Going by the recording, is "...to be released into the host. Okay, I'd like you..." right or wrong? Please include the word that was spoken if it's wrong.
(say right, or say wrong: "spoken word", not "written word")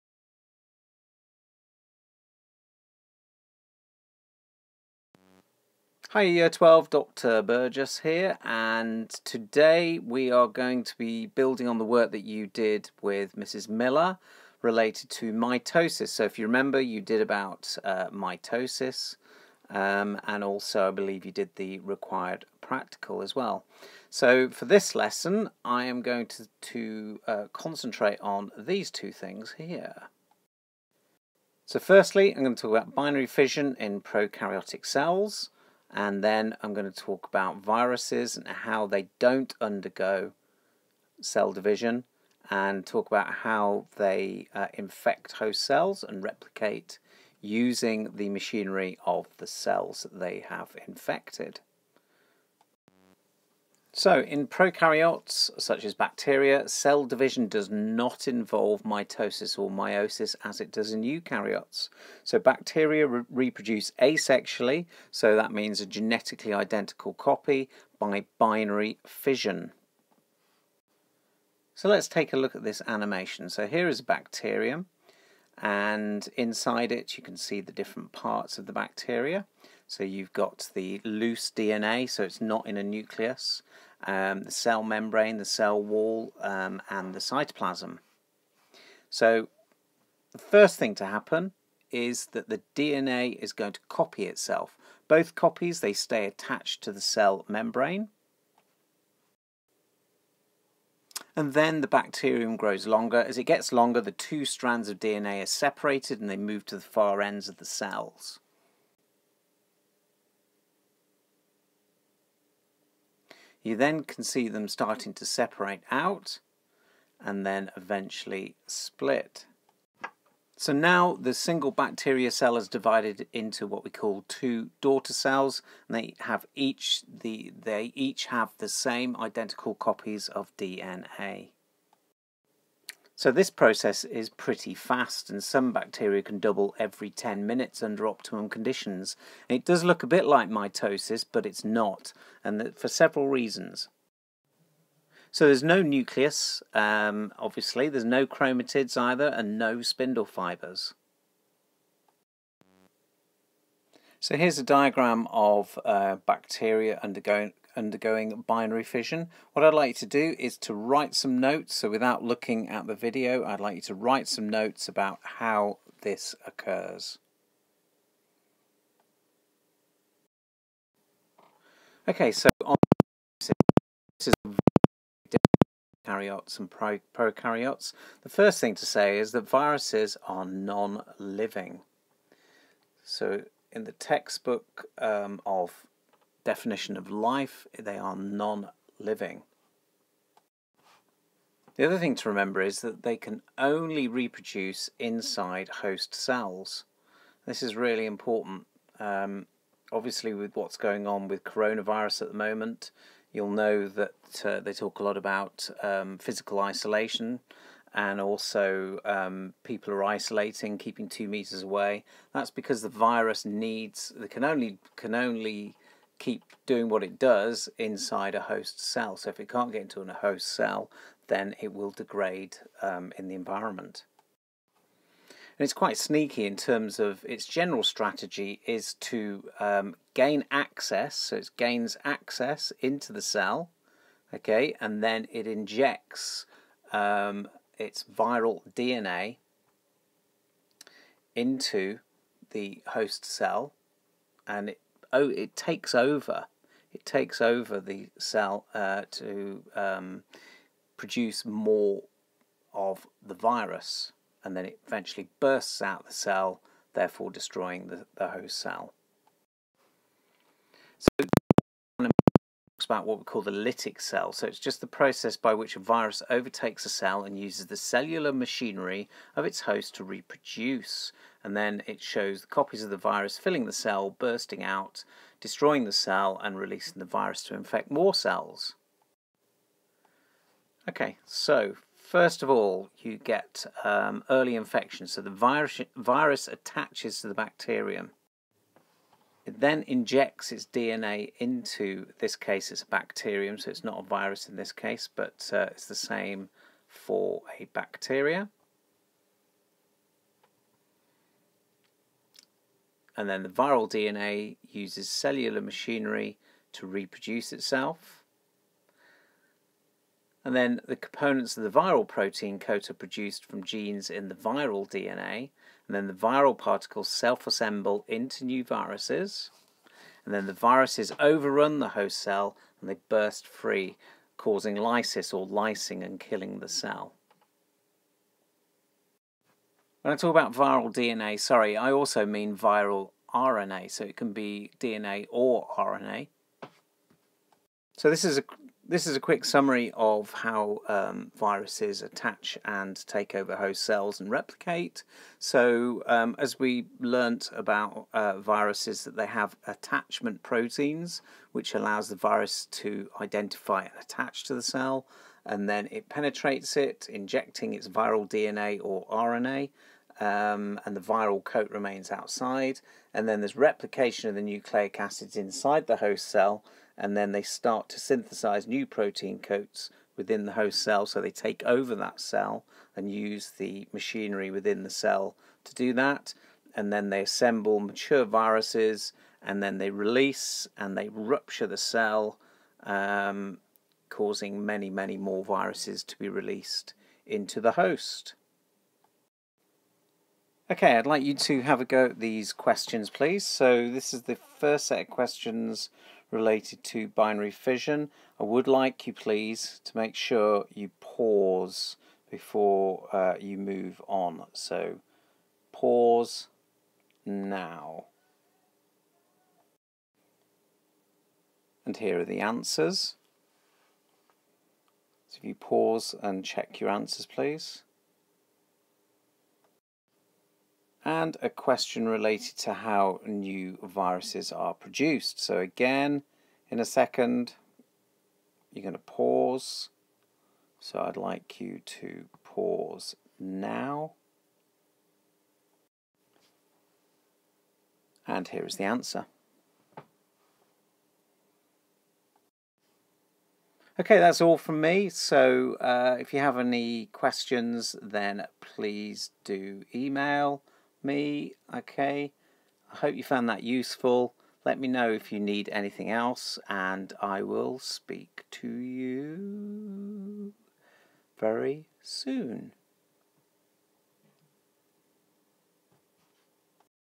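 right.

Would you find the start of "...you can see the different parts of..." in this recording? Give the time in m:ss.
1:17.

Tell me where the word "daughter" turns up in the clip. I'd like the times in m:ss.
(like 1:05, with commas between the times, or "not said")
2:04.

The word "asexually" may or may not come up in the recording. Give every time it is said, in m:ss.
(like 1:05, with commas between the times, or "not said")
1:04.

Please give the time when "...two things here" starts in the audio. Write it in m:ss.
0:28.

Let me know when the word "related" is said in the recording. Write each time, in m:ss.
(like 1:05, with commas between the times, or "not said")
0:14, 6:36, 7:02.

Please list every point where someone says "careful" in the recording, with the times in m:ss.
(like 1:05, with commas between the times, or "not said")
not said.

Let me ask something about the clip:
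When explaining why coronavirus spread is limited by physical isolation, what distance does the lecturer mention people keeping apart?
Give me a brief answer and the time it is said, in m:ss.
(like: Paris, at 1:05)
2 meters, at 3:31.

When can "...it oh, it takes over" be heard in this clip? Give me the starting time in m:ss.
4:04.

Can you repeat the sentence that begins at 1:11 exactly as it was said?
So let's take a look at this animation.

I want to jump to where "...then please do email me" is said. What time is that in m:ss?
7:28.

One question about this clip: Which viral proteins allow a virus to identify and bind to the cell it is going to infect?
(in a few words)
attachment proteins.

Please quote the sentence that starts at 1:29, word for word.
So the first thing to happen is that the DNA is going to copy itself.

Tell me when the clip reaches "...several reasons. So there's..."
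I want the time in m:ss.
2:22.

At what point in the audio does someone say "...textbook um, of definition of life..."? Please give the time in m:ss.
3:03.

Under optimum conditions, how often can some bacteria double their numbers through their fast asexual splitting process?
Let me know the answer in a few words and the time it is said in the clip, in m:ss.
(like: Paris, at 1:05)
every 10 minutes, at 2:16.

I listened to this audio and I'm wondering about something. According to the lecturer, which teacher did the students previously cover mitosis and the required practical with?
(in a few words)
Mrs. Miller.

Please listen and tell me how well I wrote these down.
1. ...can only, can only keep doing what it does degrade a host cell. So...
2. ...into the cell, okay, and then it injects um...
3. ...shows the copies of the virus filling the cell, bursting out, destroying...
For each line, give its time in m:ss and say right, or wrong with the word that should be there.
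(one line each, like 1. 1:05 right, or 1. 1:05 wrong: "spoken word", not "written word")
1. 3:34 wrong: "inside", not "degrade"
2. 3:52 right
3. 4:32 right.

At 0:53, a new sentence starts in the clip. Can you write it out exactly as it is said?
So in prokaryotes, such as bacteria, cell division does not involve mitosis or meiosis as it does in eukaryotes.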